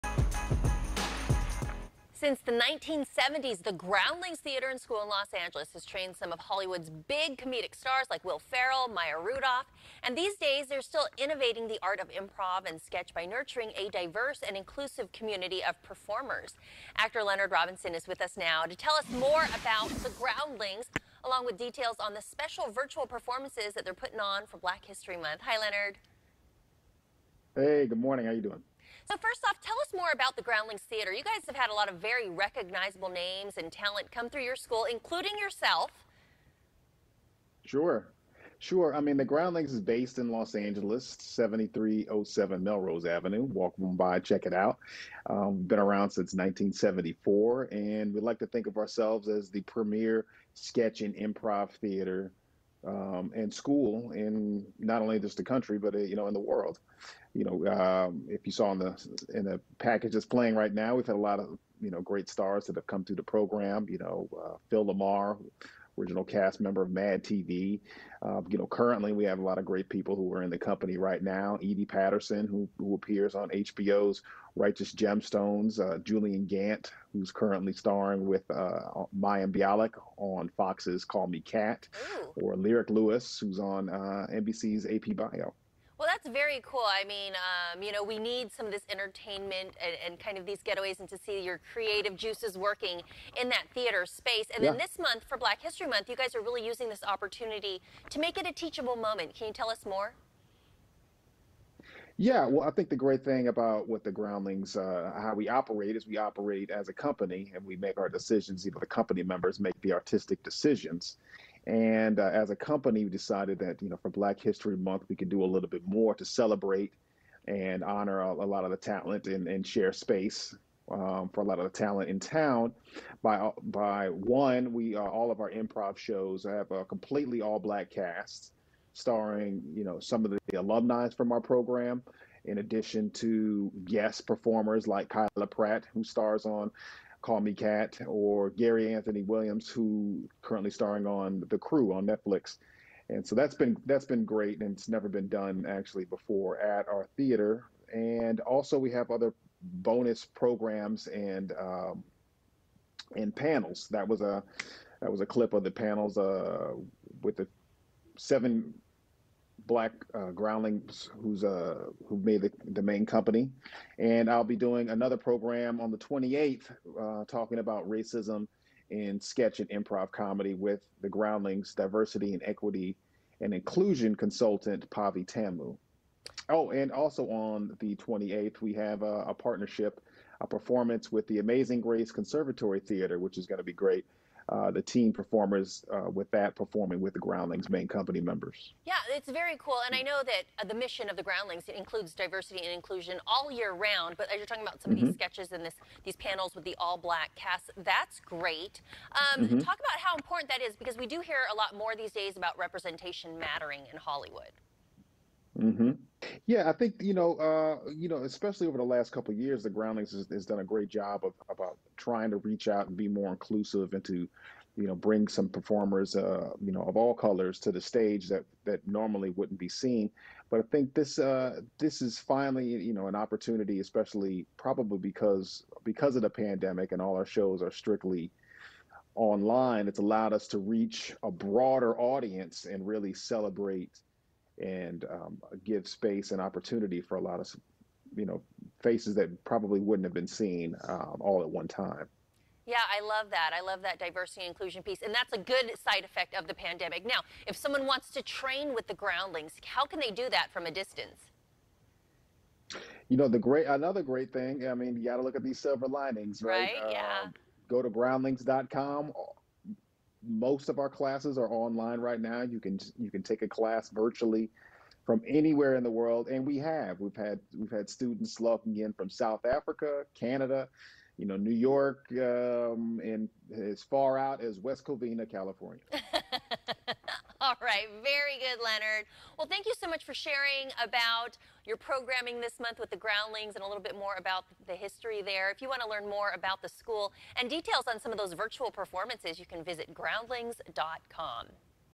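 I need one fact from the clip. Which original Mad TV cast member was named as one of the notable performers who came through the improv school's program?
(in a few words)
Phil LaMarr.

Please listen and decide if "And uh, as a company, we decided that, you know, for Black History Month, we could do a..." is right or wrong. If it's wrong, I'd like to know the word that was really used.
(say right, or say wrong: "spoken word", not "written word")
right.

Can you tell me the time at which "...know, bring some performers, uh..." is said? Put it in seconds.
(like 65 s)
214 s.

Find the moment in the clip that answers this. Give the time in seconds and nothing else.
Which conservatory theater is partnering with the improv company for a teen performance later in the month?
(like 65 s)
181 s.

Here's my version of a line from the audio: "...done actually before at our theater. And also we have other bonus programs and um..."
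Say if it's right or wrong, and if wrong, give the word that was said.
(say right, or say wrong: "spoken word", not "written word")
right.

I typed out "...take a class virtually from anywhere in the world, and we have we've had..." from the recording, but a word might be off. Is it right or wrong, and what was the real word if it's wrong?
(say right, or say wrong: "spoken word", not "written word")
right.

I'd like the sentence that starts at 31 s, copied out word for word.
You guys have had a lot of very recognizable names and talent come through your school, including yourself.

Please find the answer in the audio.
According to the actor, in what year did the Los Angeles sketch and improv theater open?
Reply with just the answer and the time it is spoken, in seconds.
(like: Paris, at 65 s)
1974, at 46 s.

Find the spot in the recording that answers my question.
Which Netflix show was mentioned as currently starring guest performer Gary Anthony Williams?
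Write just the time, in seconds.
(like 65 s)
141 s.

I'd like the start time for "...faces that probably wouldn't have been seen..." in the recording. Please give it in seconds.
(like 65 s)
238 s.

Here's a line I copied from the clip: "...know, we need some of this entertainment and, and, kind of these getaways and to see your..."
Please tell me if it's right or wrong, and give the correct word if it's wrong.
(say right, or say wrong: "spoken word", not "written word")
right.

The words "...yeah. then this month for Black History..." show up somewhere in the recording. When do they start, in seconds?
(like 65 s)
94 s.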